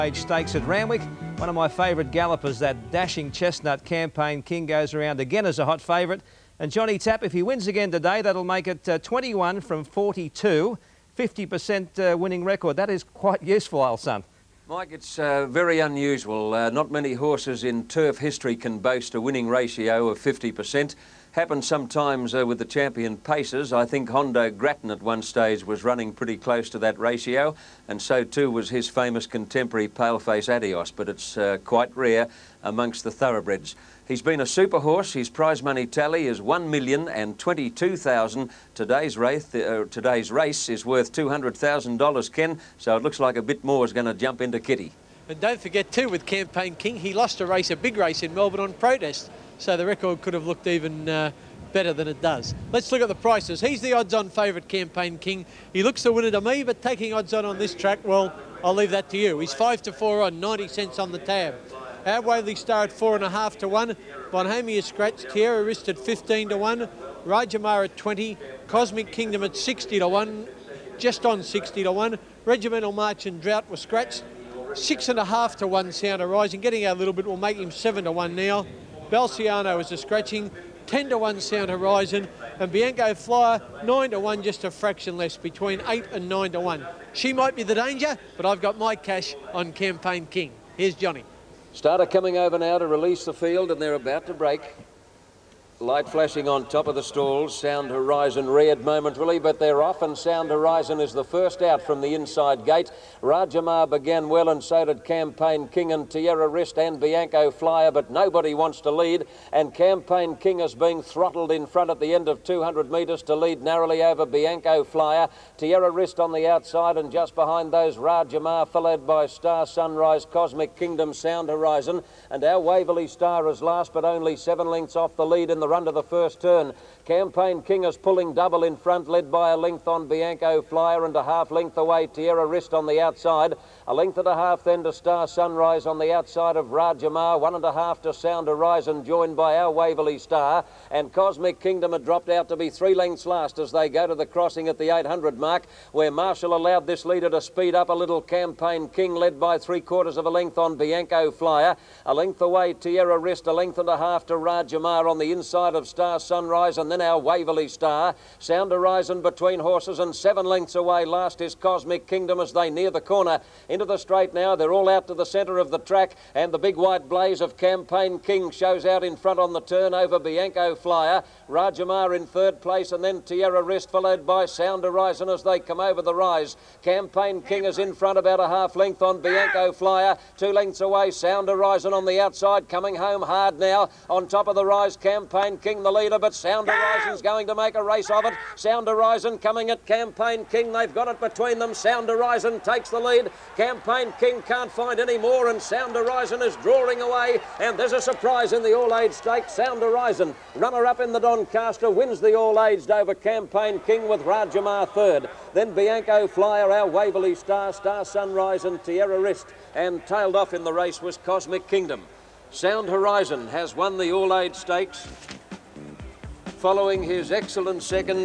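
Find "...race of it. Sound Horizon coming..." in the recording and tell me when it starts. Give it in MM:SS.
03:07.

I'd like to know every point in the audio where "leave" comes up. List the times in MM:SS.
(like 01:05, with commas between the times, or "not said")
00:58.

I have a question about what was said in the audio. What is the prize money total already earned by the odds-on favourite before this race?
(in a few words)
$1,022,000.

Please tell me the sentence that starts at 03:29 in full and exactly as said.
And tailed off in the race was Cosmic Kingdom.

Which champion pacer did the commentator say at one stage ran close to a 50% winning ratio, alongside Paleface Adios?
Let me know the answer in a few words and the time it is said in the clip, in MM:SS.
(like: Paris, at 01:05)
Hondo Grattan, at 00:24.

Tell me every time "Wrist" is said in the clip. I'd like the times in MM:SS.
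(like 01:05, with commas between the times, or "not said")
01:05, 02:12, 02:33.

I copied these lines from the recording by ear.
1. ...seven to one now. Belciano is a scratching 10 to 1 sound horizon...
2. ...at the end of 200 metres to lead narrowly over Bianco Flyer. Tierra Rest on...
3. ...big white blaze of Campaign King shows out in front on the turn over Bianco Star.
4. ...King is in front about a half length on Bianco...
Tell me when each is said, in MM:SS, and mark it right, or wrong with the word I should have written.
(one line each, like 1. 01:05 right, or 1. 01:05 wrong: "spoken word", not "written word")
1. 01:17 right
2. 01:51 right
3. 02:46 wrong: "Flyer", not "Star"
4. 02:57 right.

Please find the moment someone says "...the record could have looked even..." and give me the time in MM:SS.
00:49.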